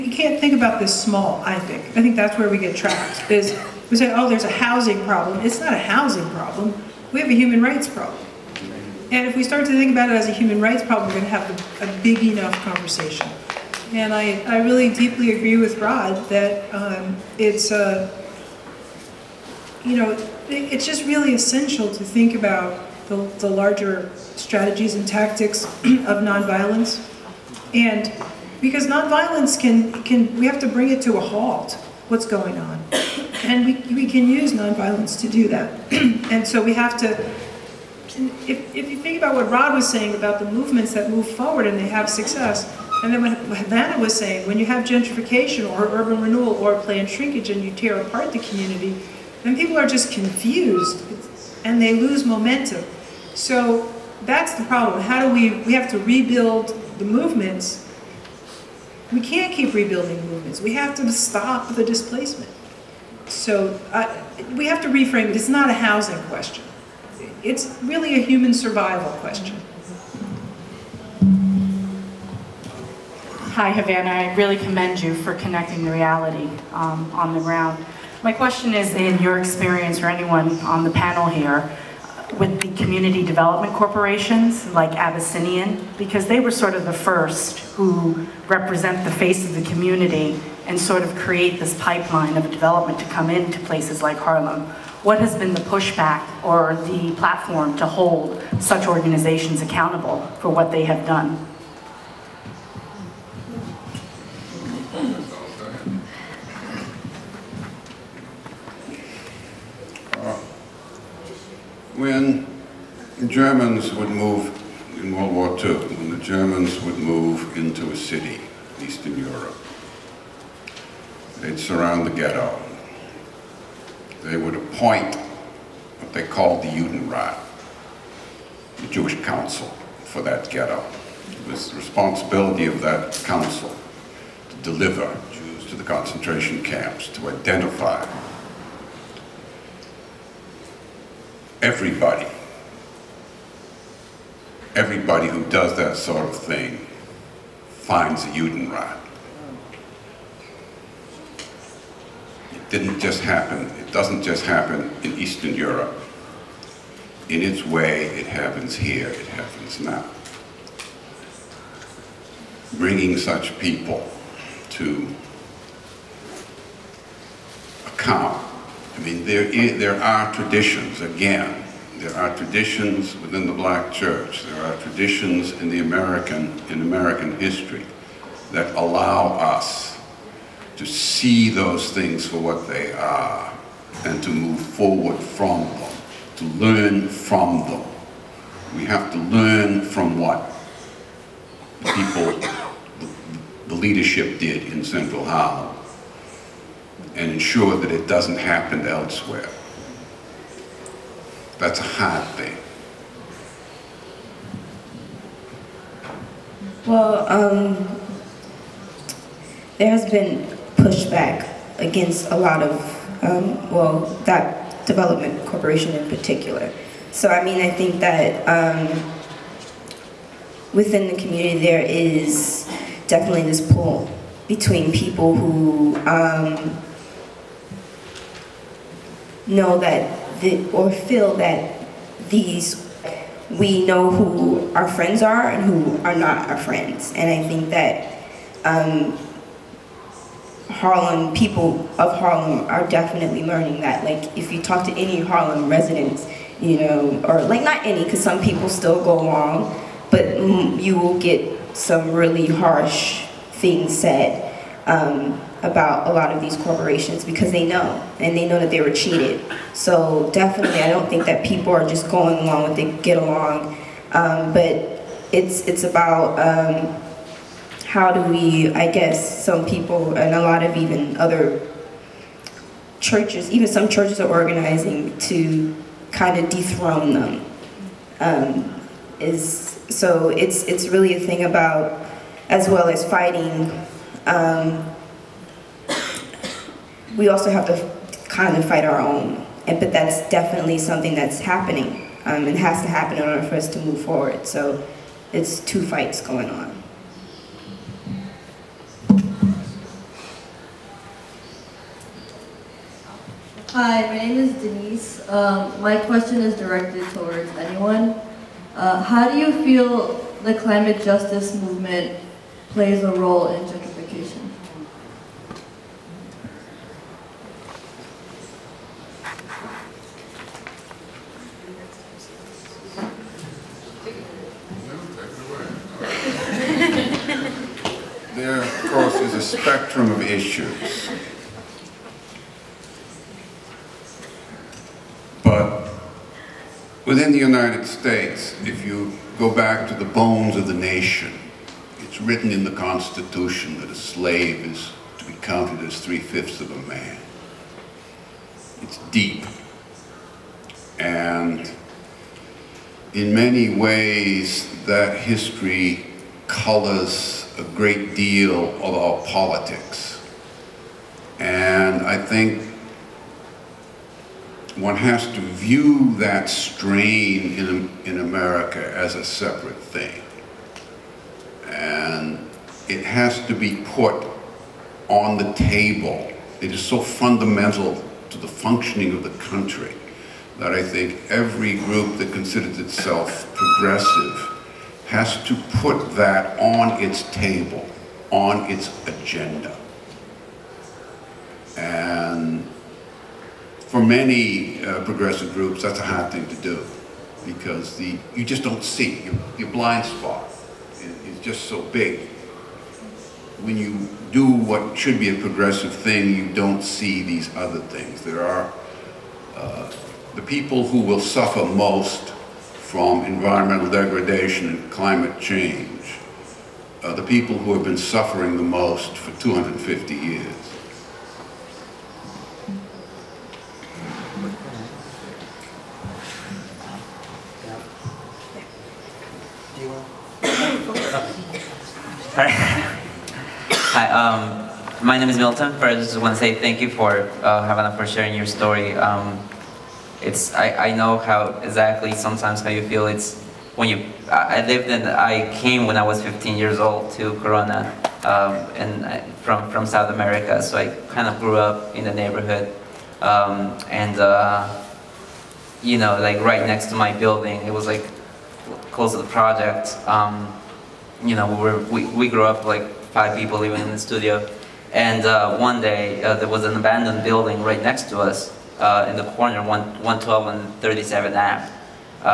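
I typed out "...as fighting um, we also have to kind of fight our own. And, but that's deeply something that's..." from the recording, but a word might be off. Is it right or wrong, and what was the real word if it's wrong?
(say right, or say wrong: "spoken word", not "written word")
wrong: "definitely", not "deeply".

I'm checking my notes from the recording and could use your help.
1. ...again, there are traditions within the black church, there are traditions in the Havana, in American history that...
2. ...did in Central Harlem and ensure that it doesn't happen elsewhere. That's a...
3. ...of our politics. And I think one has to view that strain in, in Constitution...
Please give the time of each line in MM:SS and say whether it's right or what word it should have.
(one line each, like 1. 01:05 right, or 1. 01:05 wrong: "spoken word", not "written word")
1. 02:51 wrong: "American", not "Havana"
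2. 03:14 right
3. 05:58 wrong: "America", not "Constitution".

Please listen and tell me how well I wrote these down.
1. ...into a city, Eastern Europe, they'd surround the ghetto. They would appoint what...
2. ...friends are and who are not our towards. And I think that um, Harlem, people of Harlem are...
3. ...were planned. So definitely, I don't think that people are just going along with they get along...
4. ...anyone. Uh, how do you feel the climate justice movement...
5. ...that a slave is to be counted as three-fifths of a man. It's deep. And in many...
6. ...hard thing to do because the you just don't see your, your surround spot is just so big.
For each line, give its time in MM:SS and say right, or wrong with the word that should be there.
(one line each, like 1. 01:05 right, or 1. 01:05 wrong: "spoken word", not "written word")
1. 01:57 right
2. 03:54 wrong: "friends", not "towards"
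3. 04:18 wrong: "cheated", not "planned"
4. 05:07 right
5. 05:43 right
6. 06:36 wrong: "blind", not "surround".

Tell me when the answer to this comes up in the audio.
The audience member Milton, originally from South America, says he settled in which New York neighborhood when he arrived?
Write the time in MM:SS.
07:27.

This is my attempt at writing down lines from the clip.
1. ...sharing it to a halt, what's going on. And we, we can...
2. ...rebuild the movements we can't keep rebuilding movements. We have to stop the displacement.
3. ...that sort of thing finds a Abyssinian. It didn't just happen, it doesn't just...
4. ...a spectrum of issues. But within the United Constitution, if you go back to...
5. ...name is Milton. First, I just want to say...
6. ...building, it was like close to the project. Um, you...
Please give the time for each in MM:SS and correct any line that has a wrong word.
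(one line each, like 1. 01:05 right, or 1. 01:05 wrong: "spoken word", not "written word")
1. 00:30 wrong: "bring", not "sharing"
2. 00:55 right
3. 02:25 wrong: "Judenrat", not "Abyssinian"
4. 05:29 wrong: "States", not "Constitution"
5. 07:15 right
6. 07:37 right.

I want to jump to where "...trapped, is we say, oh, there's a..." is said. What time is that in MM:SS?
00:02.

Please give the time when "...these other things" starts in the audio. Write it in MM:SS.
06:47.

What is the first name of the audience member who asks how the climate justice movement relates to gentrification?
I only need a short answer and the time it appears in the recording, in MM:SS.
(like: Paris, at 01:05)
Denise, at 05:04.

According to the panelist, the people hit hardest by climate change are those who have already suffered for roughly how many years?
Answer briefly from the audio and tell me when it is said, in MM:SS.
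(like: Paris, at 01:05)
250 years, at 06:59.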